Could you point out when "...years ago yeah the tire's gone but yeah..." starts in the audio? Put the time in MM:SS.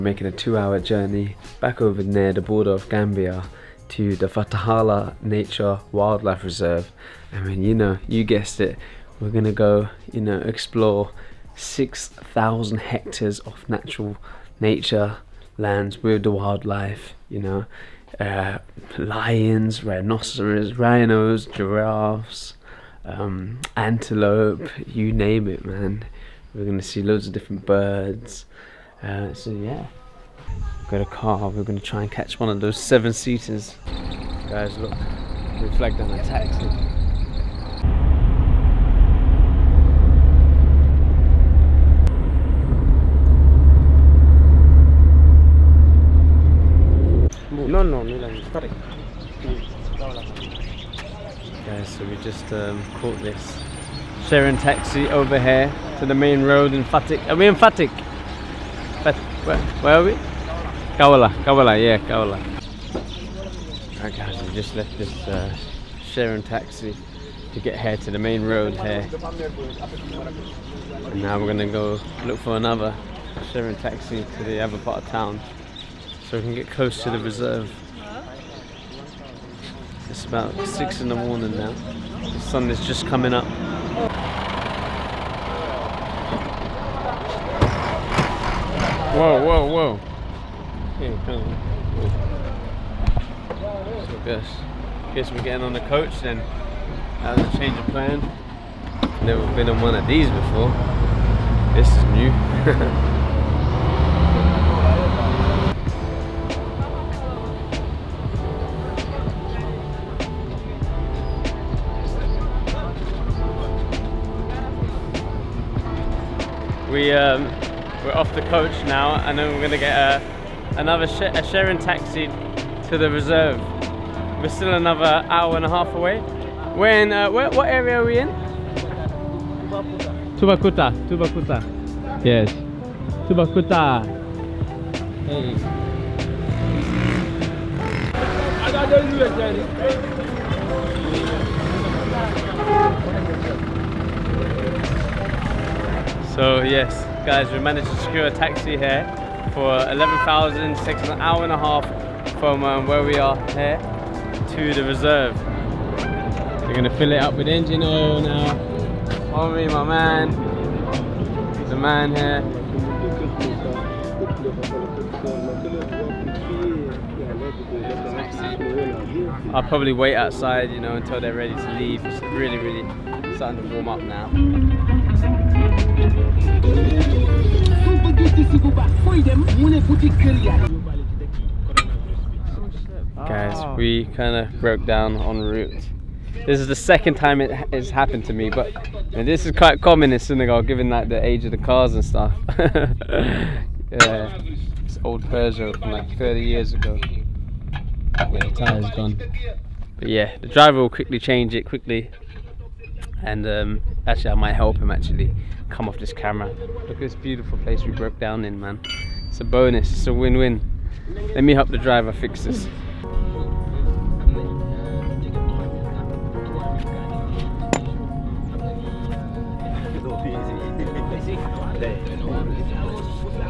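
03:16.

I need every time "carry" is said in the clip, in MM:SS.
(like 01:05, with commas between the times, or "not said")
not said.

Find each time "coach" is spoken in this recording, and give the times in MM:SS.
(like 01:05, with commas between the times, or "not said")
01:35, 01:58.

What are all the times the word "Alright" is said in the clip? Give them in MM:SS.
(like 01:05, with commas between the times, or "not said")
01:03.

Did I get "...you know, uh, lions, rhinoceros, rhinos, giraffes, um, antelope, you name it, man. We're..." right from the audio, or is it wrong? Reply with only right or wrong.
right.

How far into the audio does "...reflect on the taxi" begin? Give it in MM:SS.
00:35.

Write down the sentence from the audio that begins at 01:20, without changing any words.
It's about six in the morning now.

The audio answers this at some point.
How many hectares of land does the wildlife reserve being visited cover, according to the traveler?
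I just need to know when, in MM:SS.
00:11.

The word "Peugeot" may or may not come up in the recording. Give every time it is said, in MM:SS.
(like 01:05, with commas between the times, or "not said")
03:15.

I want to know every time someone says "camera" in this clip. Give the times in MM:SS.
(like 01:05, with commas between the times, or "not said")
03:26.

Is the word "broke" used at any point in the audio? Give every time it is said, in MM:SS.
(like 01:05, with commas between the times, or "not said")
03:04, 03:27.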